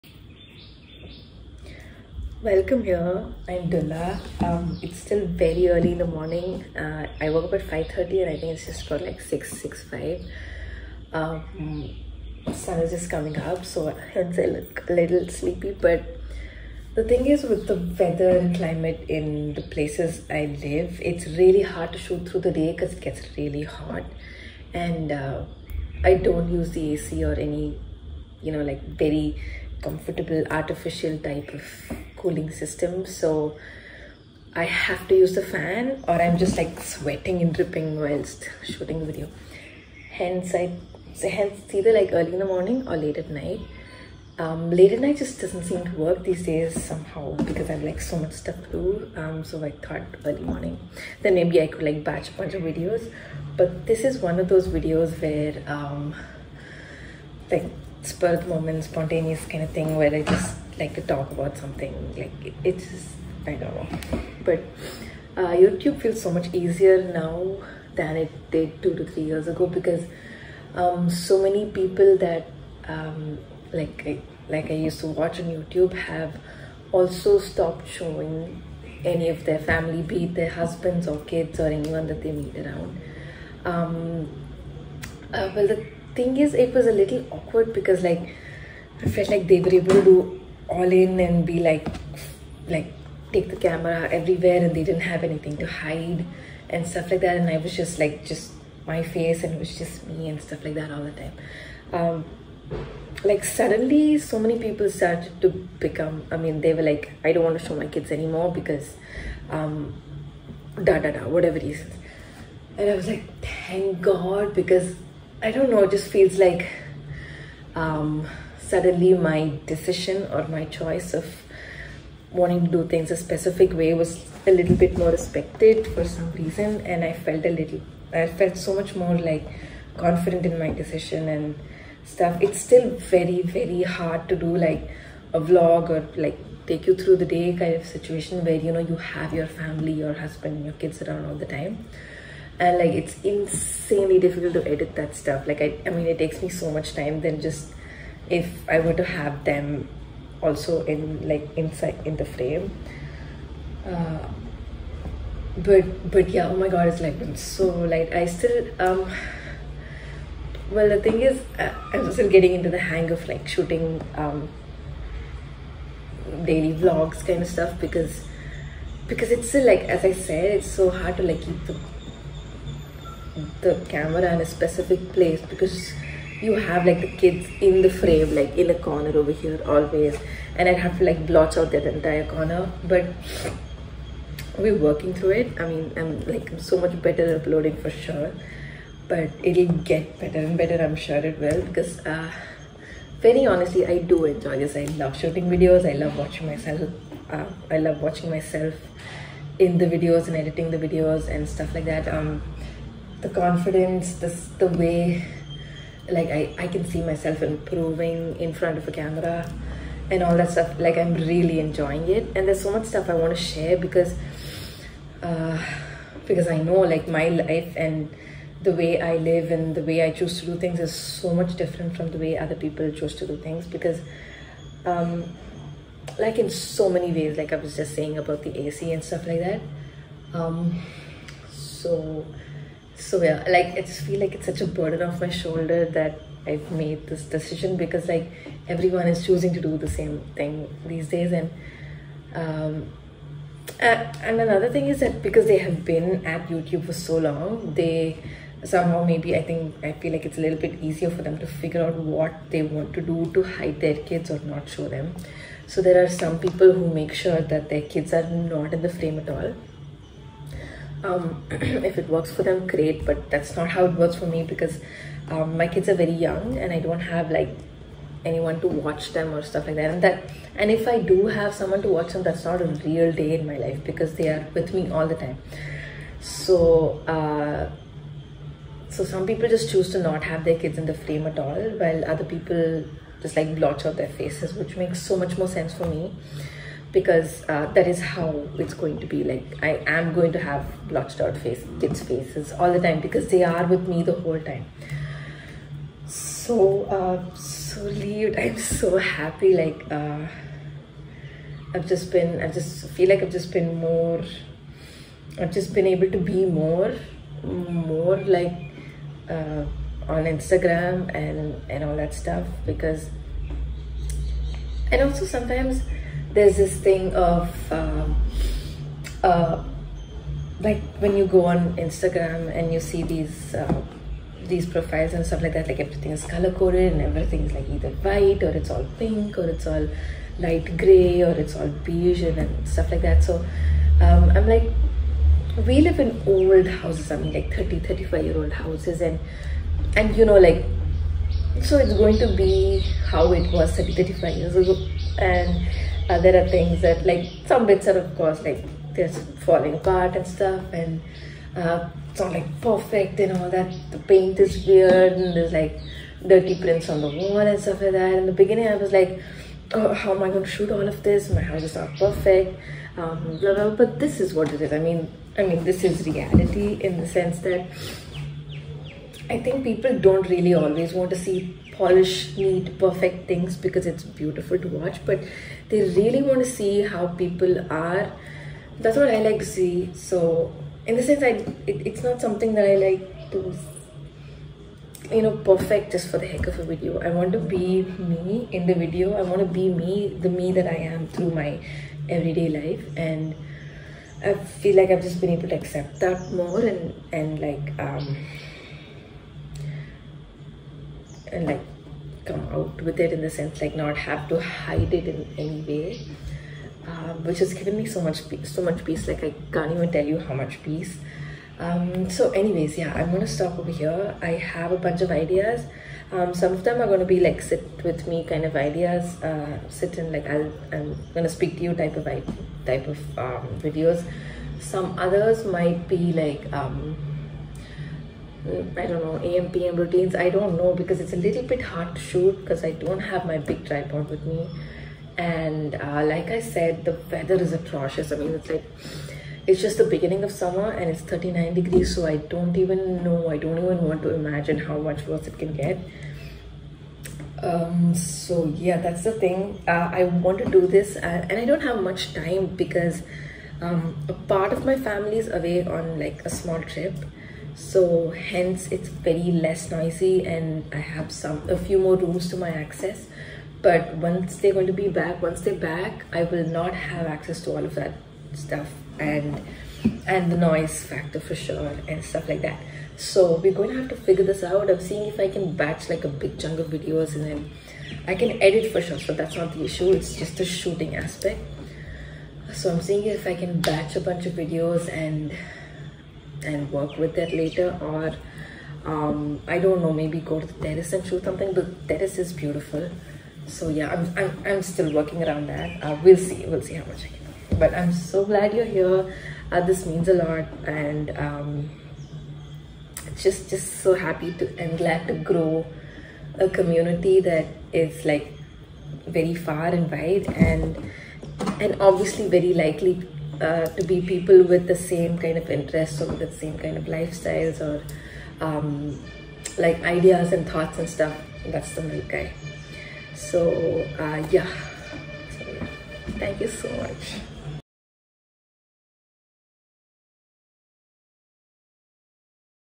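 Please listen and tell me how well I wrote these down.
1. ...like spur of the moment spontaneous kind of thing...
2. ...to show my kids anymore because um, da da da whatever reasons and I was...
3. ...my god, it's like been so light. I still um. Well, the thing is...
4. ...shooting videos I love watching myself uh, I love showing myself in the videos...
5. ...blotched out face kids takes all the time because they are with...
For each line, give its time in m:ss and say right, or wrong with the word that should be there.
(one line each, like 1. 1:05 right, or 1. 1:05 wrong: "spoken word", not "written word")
1. 0:57 right
2. 1:47 right
3. 2:36 right
4. 3:15 wrong: "watching", not "showing"
5. 4:50 wrong: "faces", not "takes".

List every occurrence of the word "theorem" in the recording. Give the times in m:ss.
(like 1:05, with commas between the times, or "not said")
not said.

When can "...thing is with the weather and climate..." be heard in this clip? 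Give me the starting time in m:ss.
0:17.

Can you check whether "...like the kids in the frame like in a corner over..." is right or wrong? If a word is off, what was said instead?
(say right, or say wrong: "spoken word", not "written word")
right.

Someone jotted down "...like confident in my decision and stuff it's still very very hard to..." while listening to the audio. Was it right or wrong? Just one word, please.
right.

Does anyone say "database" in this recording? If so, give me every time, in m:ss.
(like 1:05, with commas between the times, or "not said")
not said.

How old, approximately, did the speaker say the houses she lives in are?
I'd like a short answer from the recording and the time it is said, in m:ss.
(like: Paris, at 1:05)
30 to 35 years, at 5:37.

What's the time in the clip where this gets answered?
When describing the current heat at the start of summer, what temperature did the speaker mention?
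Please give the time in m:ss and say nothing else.
7:21.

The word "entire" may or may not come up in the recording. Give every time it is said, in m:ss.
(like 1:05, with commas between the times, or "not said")
3:01.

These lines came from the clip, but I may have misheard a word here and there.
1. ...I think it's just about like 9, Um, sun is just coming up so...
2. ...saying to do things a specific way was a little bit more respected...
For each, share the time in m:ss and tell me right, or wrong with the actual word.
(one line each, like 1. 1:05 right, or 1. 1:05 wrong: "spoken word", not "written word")
1. 0:08 wrong: "6", not "9"
2. 2:02 wrong: "wanting", not "saying".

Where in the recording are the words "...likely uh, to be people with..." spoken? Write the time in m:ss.
8:32.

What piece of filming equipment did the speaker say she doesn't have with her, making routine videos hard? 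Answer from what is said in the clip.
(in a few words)
big tripod.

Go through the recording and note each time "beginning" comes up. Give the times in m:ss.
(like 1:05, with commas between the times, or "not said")
5:58, 7:19.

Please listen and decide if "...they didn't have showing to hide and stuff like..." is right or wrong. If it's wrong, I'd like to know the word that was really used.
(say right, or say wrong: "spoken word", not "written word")
wrong: "anything", not "showing".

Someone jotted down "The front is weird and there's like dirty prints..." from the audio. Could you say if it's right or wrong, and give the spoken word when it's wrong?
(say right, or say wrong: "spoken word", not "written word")
wrong: "paint", not "front".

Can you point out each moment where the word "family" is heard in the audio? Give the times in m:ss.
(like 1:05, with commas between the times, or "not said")
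1:19, 2:19, 7:34.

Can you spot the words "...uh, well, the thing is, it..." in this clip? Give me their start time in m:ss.
1:25.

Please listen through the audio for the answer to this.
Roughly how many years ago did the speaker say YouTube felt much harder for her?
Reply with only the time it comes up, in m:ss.
1:08.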